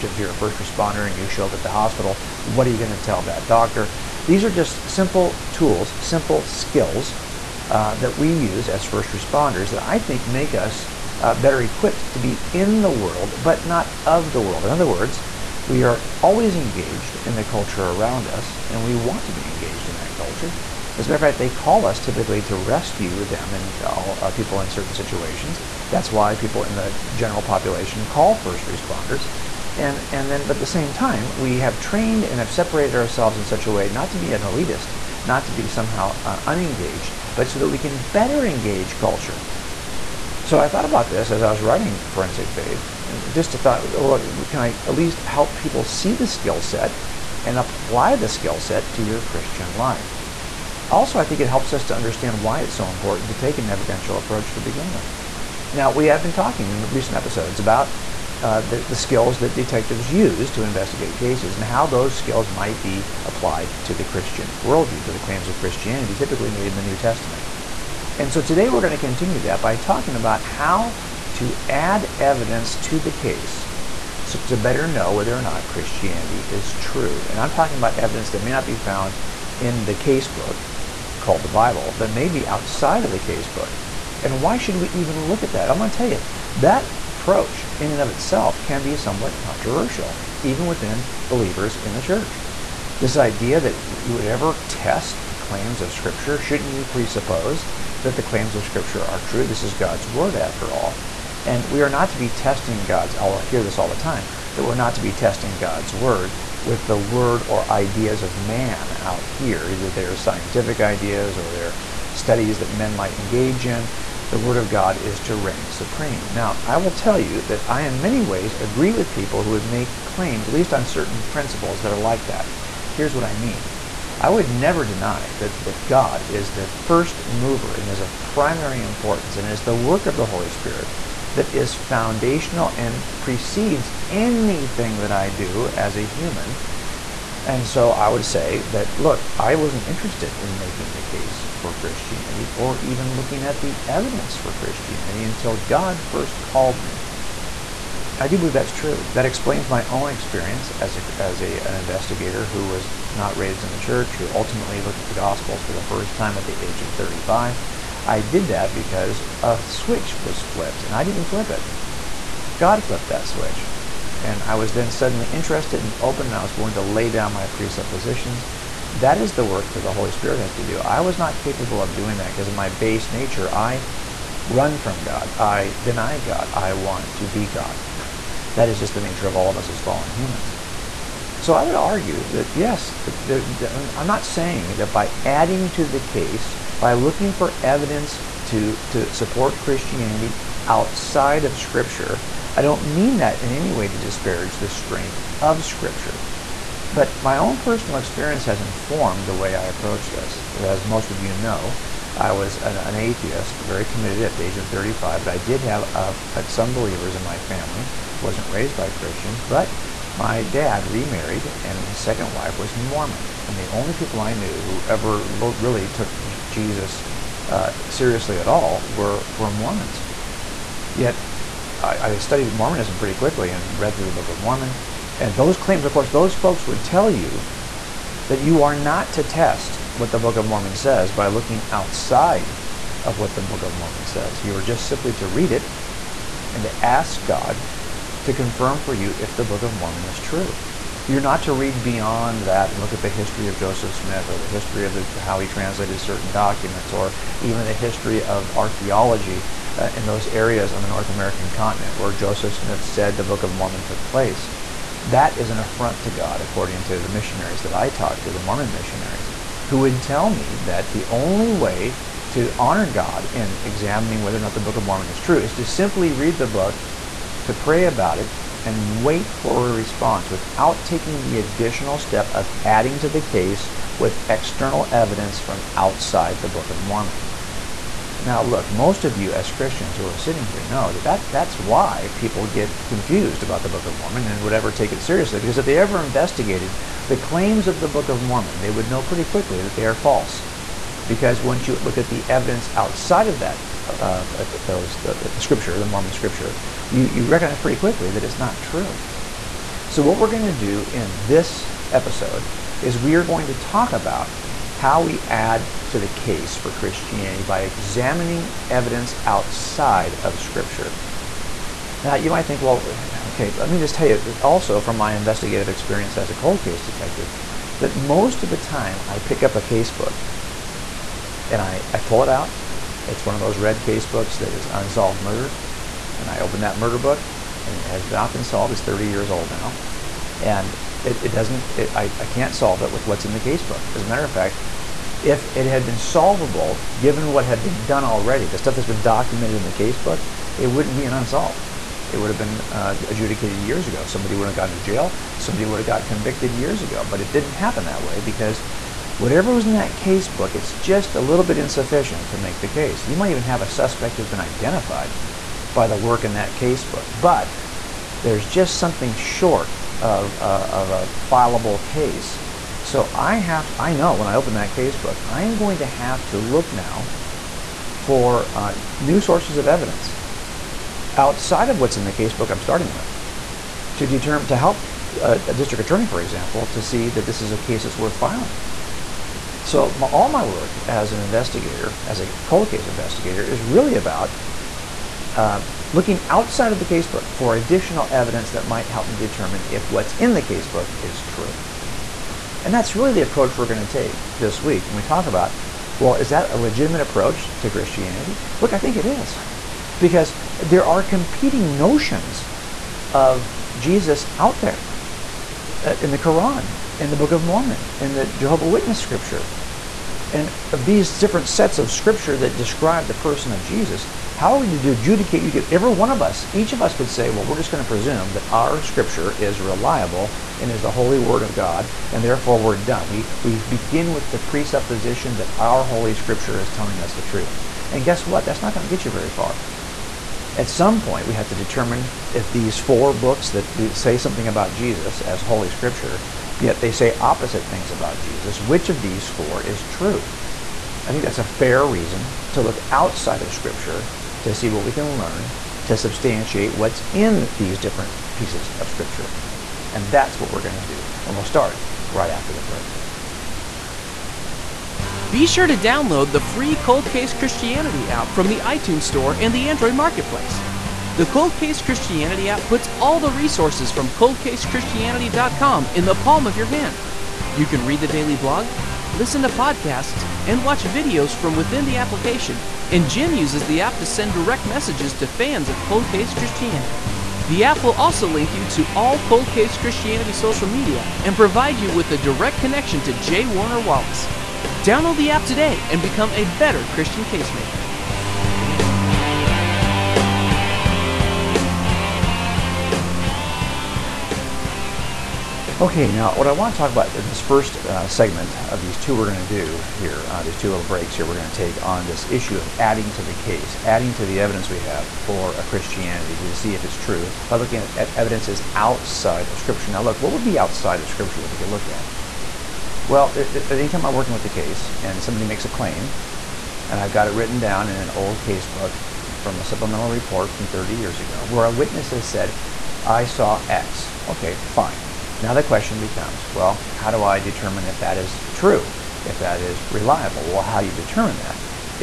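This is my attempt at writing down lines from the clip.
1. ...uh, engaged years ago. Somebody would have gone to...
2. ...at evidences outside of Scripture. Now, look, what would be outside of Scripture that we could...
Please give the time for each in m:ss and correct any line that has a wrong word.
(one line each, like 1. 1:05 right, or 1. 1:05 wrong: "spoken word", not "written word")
1. 5:42 wrong: "adjudicated", not "engaged"
2. 8:27 right.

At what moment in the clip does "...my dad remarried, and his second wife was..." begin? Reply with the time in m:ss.
3:30.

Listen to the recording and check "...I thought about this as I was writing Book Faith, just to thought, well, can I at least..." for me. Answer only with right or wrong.
wrong.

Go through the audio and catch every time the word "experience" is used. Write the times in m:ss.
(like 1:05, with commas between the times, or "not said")
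2:30, 3:17, 5:15.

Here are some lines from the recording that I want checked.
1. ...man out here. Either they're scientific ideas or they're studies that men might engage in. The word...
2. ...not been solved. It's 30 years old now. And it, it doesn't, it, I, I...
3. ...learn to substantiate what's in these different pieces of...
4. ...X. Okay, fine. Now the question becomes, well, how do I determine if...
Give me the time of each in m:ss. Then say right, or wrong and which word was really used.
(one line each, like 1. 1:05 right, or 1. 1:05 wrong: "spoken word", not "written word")
1. 1:48 right
2. 5:28 right
3. 7:25 right
4. 8:43 right.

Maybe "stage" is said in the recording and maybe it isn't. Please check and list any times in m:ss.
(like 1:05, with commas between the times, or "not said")
not said.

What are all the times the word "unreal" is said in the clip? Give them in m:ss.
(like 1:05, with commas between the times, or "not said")
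not said.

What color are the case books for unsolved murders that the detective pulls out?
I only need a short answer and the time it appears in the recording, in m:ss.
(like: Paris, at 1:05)
Red, at 5:23.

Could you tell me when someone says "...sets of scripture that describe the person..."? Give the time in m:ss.
6:51.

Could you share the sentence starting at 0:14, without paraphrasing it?
In other words, we are always engaged in the culture around us, and we want to be engaged in that culture.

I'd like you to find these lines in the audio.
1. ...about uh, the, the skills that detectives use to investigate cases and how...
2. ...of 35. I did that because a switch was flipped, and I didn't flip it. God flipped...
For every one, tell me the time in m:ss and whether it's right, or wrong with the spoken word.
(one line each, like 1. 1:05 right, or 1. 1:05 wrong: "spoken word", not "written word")
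1. 0:57 right
2. 2:36 right.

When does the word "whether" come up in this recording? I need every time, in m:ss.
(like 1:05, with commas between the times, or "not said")
1:15, 4:24.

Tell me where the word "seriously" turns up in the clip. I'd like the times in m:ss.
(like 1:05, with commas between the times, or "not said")
3:37, 4:45.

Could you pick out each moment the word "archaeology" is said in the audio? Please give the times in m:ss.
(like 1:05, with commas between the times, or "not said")
4:08.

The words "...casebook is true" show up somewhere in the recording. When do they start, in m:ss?
6:30.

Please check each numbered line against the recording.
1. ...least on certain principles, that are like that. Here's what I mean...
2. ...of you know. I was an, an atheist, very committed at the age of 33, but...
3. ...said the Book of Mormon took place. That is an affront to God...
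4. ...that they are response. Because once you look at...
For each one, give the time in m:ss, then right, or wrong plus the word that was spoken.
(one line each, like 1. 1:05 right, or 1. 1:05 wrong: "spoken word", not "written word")
1. 2:00 right
2. 3:21 wrong: "35", not "33"
3. 4:12 right
4. 4:49 wrong: "false", not "response".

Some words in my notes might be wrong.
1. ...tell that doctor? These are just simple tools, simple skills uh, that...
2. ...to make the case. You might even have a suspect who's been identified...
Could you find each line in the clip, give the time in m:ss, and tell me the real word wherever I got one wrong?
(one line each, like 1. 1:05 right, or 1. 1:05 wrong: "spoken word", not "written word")
1. 0:02 right
2. 5:52 right.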